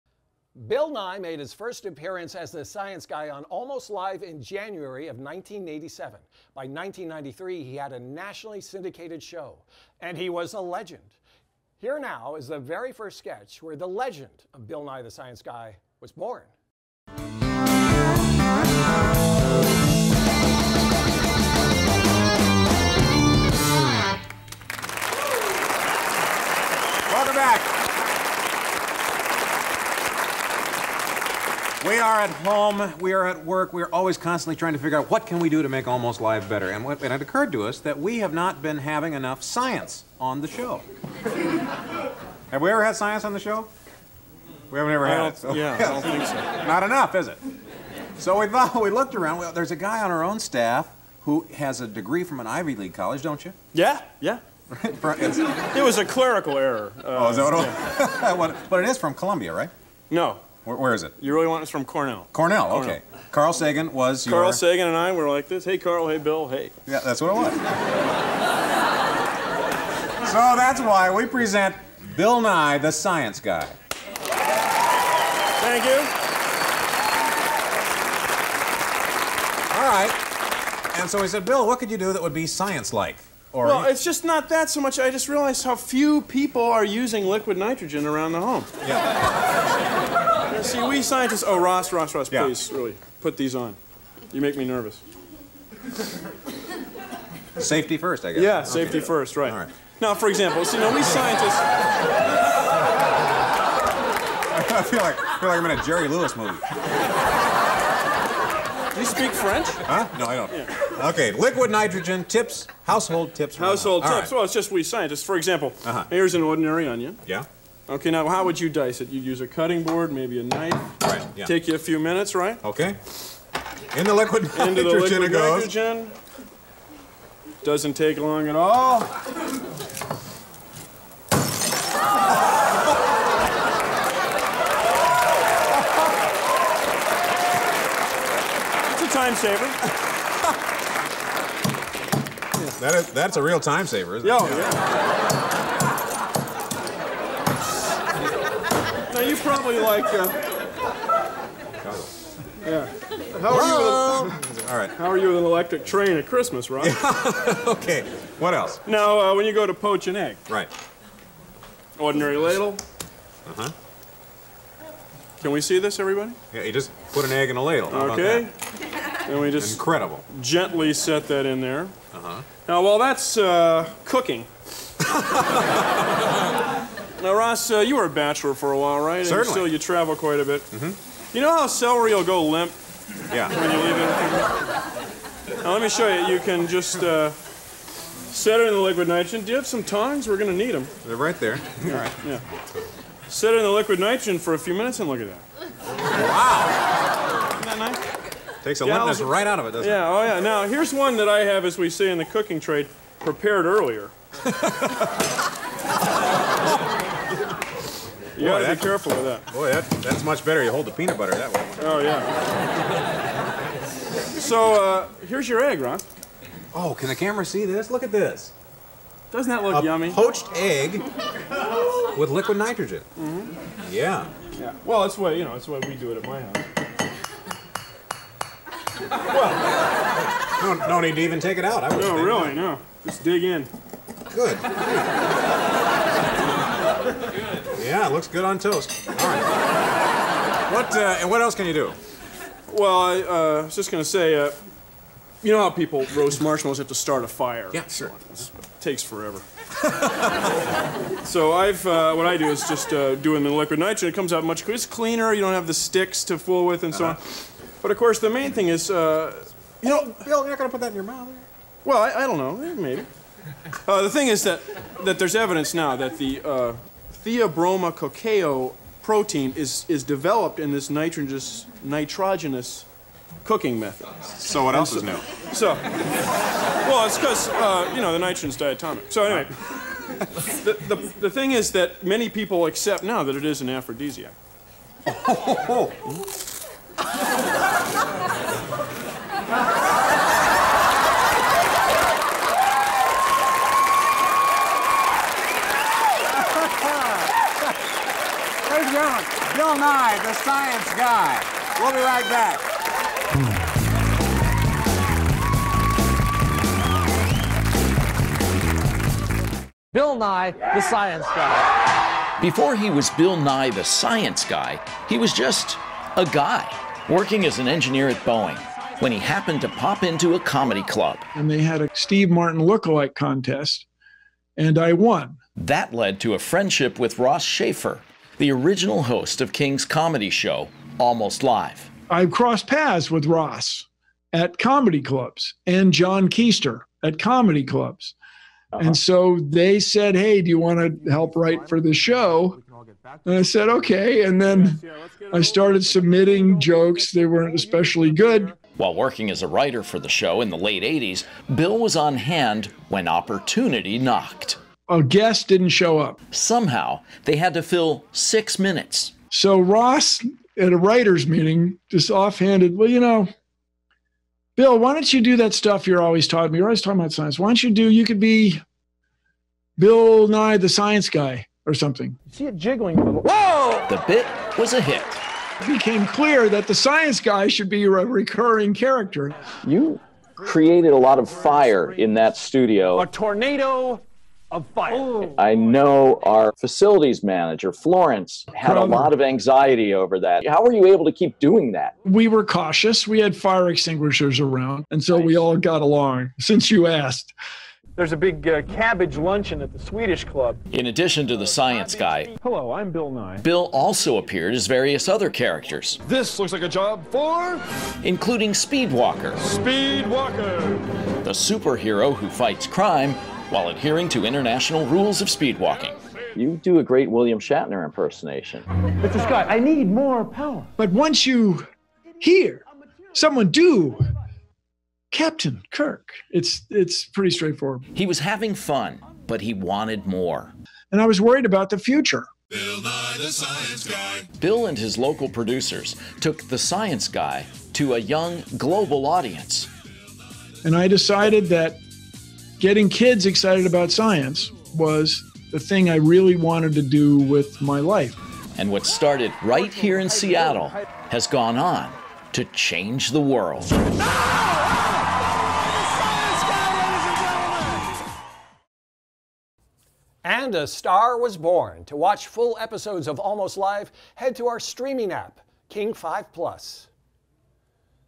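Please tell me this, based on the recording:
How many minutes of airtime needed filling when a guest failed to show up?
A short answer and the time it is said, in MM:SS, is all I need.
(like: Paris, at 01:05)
6, at 05:58.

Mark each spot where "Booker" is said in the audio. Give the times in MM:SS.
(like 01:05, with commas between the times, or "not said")
not said.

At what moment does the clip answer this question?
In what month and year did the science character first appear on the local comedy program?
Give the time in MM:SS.
00:04.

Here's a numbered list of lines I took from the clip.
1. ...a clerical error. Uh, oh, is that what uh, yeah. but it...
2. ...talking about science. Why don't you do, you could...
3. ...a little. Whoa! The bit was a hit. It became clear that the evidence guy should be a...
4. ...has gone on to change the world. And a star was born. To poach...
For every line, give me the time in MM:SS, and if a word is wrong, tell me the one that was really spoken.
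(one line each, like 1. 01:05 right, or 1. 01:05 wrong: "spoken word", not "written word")
1. 00:55 right
2. 06:06 right
3. 06:12 wrong: "science", not "evidence"
4. 07:31 wrong: "watch", not "poach".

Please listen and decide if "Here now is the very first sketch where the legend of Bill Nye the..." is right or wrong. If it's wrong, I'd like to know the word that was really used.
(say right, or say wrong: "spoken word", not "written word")
right.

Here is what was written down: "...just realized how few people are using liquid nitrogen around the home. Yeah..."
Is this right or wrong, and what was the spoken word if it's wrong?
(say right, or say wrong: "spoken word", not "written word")
right.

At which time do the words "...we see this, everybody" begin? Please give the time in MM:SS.
02:45.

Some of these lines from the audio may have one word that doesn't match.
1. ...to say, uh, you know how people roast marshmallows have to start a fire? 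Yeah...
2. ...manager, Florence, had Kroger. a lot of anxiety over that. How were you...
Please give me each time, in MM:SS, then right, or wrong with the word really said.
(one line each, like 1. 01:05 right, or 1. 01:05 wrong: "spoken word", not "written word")
1. 04:04 right
2. 06:27 right.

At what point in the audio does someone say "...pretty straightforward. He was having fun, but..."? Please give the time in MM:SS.
07:07.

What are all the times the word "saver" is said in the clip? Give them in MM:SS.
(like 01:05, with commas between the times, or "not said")
02:19, 02:23.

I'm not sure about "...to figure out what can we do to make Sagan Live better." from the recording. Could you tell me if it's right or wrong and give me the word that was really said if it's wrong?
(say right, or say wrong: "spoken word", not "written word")
wrong: "Almost", not "Sagan".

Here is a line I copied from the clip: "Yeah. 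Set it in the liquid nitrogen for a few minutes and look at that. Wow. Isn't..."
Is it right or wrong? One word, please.
right.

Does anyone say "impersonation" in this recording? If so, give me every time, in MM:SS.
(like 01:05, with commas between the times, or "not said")
06:57.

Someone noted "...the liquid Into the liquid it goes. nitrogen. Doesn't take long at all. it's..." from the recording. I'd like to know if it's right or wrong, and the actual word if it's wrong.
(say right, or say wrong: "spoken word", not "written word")
right.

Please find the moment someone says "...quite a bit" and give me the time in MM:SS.
03:00.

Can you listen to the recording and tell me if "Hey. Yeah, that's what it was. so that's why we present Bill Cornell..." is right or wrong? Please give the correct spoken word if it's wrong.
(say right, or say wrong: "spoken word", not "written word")
wrong: "Nye", not "Cornell".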